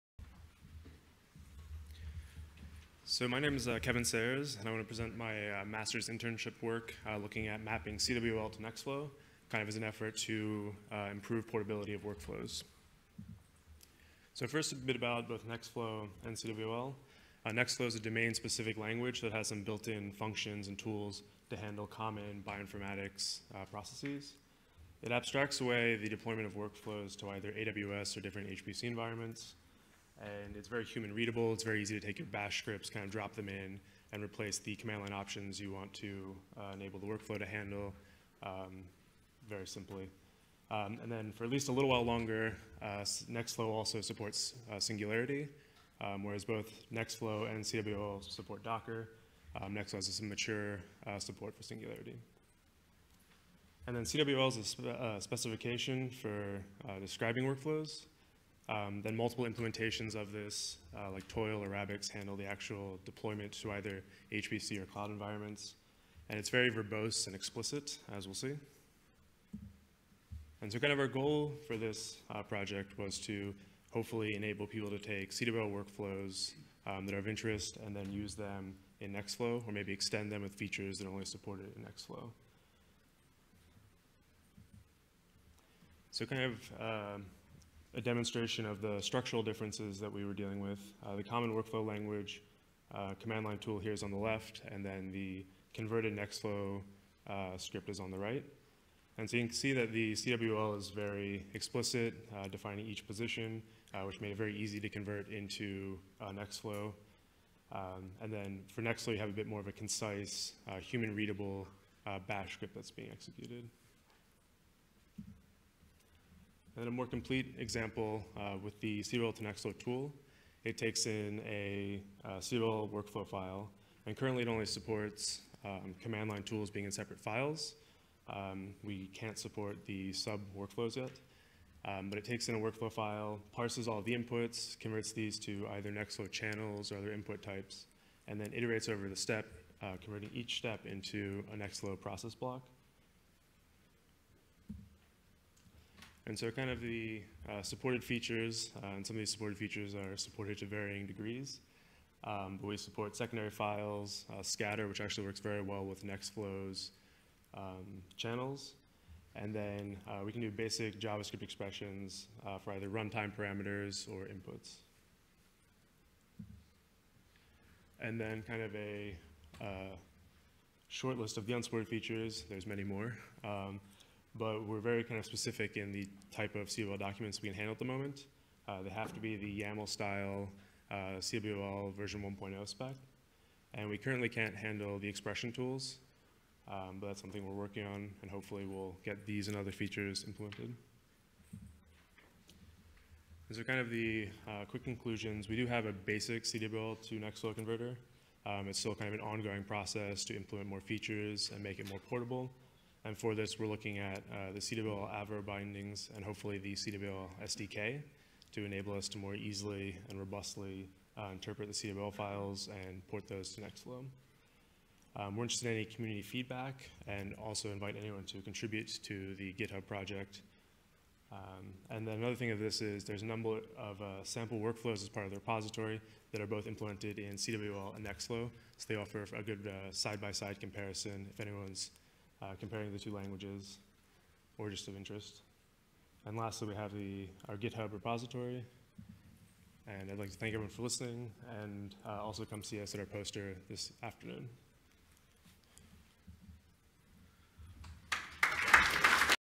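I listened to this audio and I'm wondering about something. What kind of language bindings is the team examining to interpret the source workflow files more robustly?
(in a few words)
Avro bindings.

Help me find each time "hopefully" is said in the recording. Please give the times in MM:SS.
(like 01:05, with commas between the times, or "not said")
01:13, 03:08, 03:26.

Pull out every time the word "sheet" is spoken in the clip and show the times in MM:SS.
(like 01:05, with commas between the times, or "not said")
not said.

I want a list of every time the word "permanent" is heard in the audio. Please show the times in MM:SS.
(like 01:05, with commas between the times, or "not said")
not said.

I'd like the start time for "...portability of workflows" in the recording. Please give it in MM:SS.
00:11.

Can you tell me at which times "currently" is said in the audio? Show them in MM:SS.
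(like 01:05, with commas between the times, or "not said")
02:04, 03:03.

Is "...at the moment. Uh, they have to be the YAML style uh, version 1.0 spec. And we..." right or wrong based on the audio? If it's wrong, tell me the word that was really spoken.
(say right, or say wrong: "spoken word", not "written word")
right.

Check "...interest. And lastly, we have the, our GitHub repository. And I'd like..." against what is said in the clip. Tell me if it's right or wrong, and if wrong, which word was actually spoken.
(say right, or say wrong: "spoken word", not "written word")
right.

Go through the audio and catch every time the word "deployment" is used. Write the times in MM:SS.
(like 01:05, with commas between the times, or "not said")
00:26, 01:03.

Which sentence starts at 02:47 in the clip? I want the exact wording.
And then kind of a uh, short list of the unsupported features.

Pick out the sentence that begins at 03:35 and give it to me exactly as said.
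Um, we're interested in any community feedback and also invite anyone to contribute to the GitHub project.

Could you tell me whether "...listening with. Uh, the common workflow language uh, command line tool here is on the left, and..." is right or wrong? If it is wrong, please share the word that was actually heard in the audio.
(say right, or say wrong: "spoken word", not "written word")
wrong: "dealing", not "listening".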